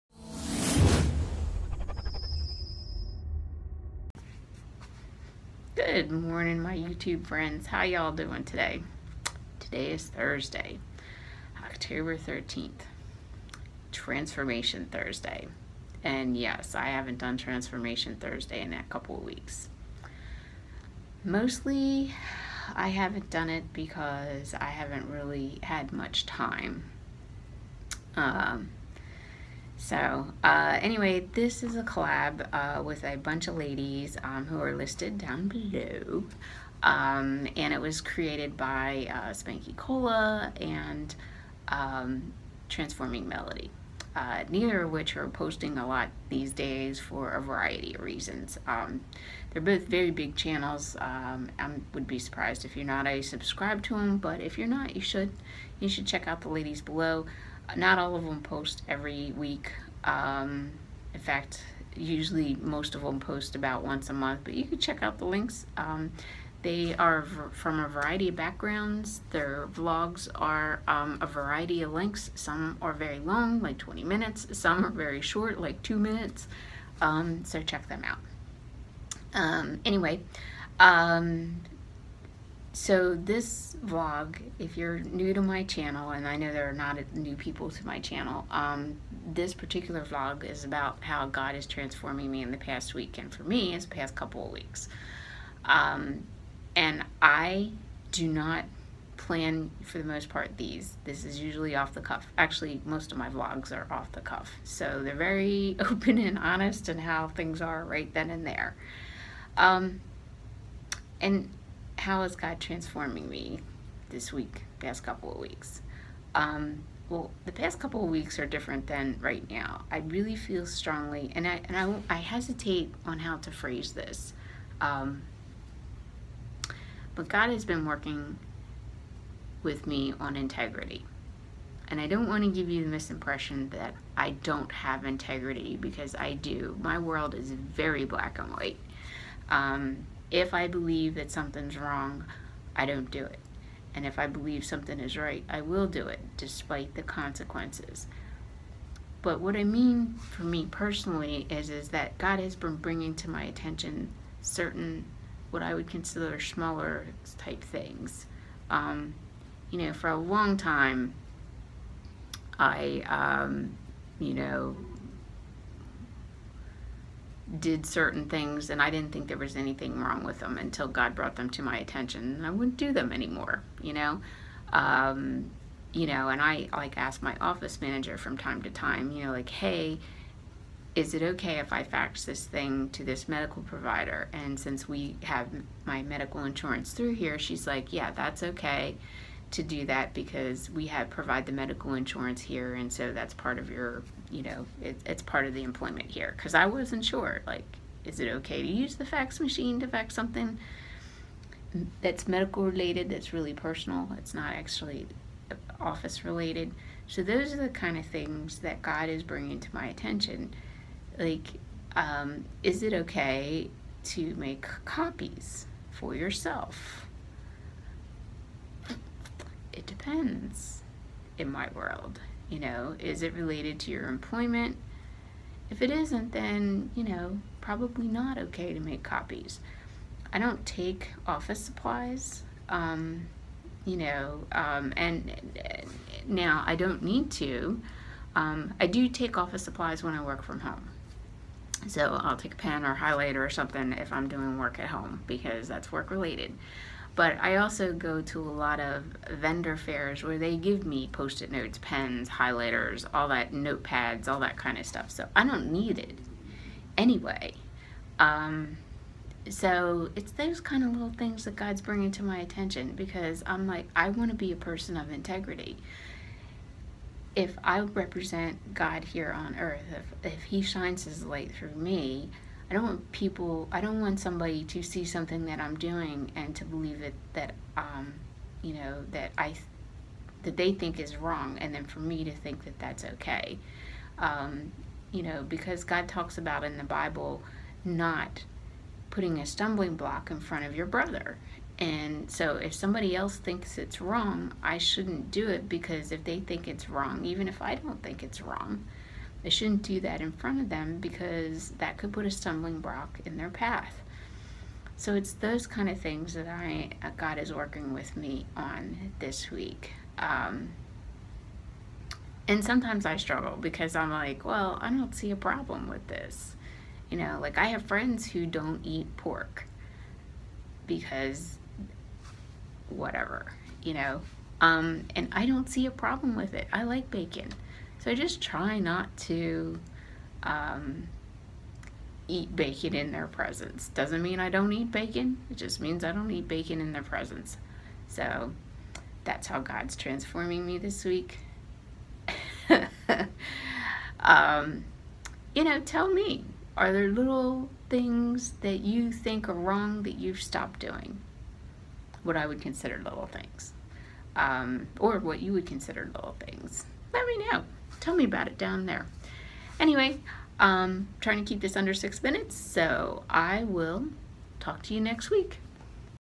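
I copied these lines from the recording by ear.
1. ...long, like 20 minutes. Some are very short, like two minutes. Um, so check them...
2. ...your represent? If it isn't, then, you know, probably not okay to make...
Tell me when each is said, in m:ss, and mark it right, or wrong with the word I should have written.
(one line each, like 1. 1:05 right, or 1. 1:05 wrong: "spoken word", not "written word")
1. 1:13 right
2. 3:43 wrong: "employment", not "represent".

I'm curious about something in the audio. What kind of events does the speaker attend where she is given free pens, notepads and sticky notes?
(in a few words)
Vendor fairs.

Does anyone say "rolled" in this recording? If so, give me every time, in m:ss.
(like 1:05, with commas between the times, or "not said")
not said.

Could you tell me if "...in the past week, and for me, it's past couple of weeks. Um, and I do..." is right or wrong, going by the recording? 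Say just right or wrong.
right.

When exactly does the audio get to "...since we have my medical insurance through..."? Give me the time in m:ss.
3:04.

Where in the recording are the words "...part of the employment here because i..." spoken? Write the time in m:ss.
3:15.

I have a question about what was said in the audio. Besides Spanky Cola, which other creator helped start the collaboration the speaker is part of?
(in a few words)
Transforming Melody.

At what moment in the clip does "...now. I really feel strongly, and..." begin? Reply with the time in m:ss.
1:59.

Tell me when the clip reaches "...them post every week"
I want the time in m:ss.
0:58.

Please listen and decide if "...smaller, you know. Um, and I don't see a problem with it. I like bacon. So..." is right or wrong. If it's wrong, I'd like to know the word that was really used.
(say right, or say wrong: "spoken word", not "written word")
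wrong: "whatever", not "smaller".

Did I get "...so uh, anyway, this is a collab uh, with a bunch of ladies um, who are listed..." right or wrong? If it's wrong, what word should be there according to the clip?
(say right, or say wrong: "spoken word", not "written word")
right.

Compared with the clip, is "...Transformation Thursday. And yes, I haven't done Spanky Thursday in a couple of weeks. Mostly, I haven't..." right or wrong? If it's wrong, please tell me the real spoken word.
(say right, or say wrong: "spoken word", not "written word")
wrong: "Transformation", not "Spanky".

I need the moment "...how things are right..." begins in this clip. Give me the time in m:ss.
1:47.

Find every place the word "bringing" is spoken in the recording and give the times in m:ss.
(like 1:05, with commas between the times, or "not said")
2:32, 3:29, 4:21.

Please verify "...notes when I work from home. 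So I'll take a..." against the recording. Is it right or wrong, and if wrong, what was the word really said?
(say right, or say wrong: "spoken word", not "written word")
wrong: "supplies", not "notes".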